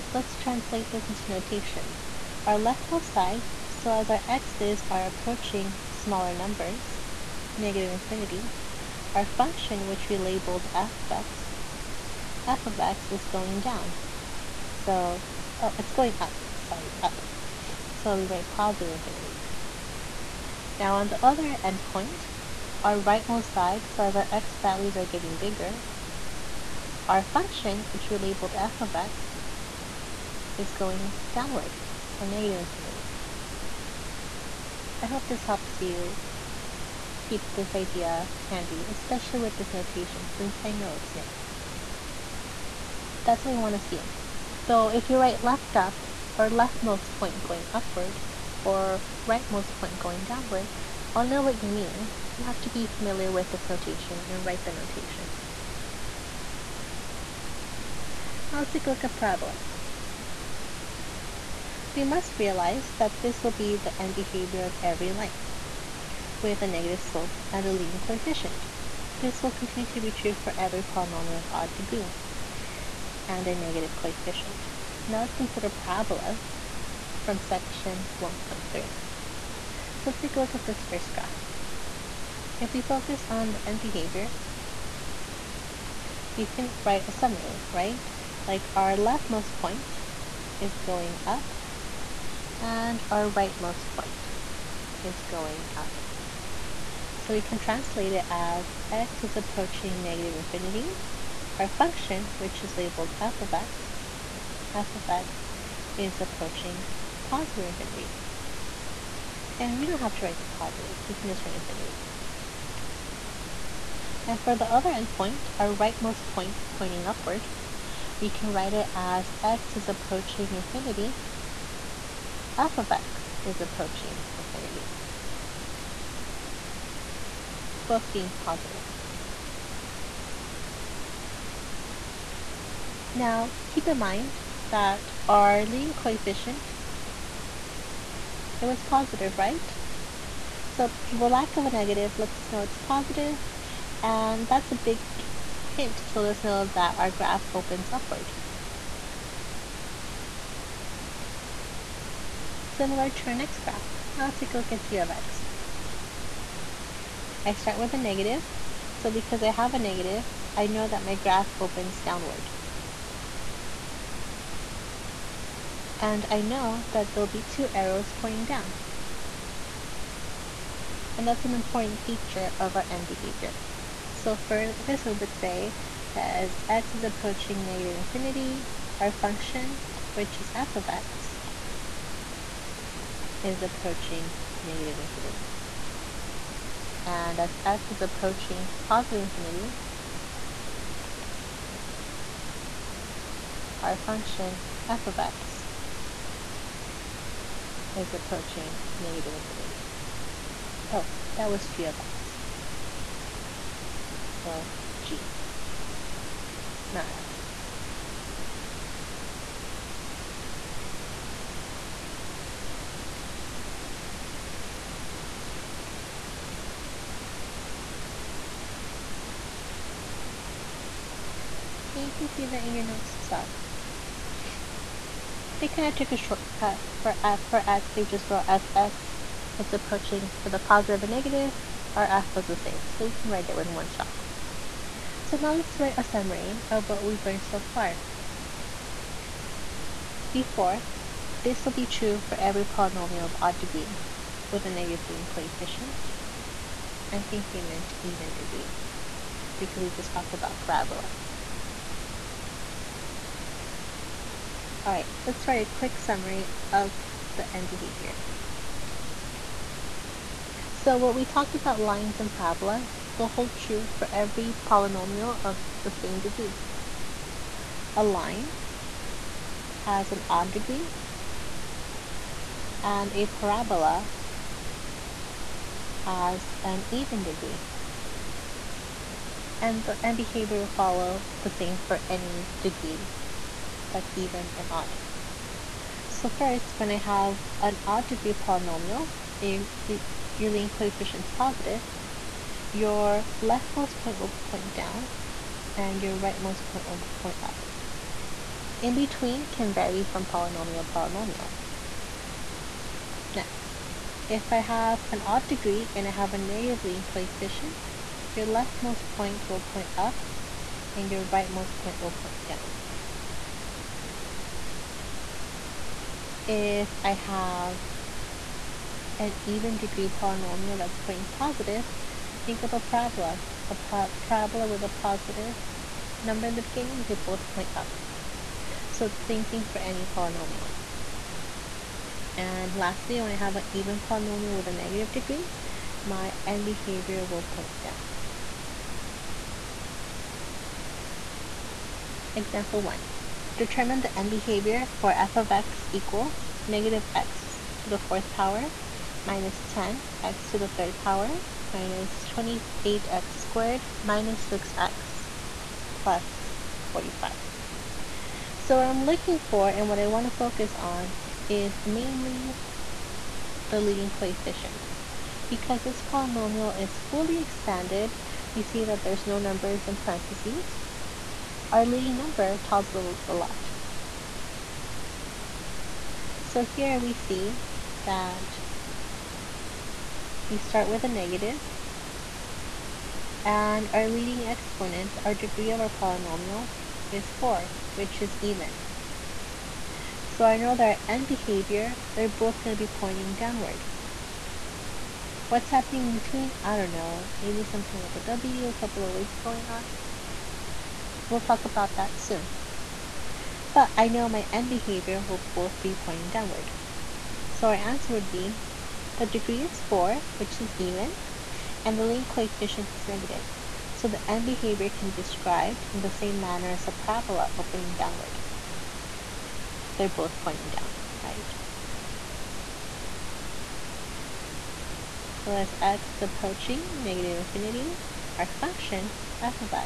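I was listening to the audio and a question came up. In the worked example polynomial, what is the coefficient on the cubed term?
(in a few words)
-10.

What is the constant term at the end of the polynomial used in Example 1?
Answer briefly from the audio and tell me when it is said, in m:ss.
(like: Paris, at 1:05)
45, at 5:55.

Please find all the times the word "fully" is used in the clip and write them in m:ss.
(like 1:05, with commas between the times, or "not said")
6:07.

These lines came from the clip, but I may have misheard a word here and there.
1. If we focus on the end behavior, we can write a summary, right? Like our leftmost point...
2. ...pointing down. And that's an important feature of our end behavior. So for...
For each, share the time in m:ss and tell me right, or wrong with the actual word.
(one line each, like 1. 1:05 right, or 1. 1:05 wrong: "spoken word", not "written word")
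1. 1:22 right
2. 2:48 right.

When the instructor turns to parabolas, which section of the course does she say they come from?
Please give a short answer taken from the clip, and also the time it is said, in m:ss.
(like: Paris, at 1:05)
Section 1.3, at 1:17.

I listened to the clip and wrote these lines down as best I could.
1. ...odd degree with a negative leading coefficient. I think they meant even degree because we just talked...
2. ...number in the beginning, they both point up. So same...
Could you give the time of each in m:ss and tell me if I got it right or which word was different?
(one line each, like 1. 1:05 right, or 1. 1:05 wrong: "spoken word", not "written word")
1. 4:03 right
2. 5:26 right.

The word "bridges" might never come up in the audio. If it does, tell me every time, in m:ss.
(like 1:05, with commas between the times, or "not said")
not said.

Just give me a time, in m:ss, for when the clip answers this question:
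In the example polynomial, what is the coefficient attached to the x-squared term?
5:51.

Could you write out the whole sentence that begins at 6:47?
So our answer would be the degree is 4, which is even, and the leading coefficient is negative.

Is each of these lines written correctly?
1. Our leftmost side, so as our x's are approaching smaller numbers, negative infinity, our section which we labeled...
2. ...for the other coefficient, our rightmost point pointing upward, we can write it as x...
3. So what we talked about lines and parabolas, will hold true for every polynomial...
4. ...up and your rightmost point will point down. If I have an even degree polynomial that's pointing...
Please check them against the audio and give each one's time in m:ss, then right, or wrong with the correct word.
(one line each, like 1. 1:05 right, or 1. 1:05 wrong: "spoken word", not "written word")
1. 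0:02 wrong: "function", not "section"
2. 1:54 wrong: "endpoint", not "coefficient"
3. 4:20 right
4. 5:09 right.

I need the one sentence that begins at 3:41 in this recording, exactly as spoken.
And you can see that in your notes as well.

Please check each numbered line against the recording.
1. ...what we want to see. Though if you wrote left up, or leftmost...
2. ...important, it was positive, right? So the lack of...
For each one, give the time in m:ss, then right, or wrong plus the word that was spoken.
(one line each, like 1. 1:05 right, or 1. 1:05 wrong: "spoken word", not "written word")
1. 0:43 wrong: "write", not "wrote"
2. 2:15 wrong: "coefficient", not "important".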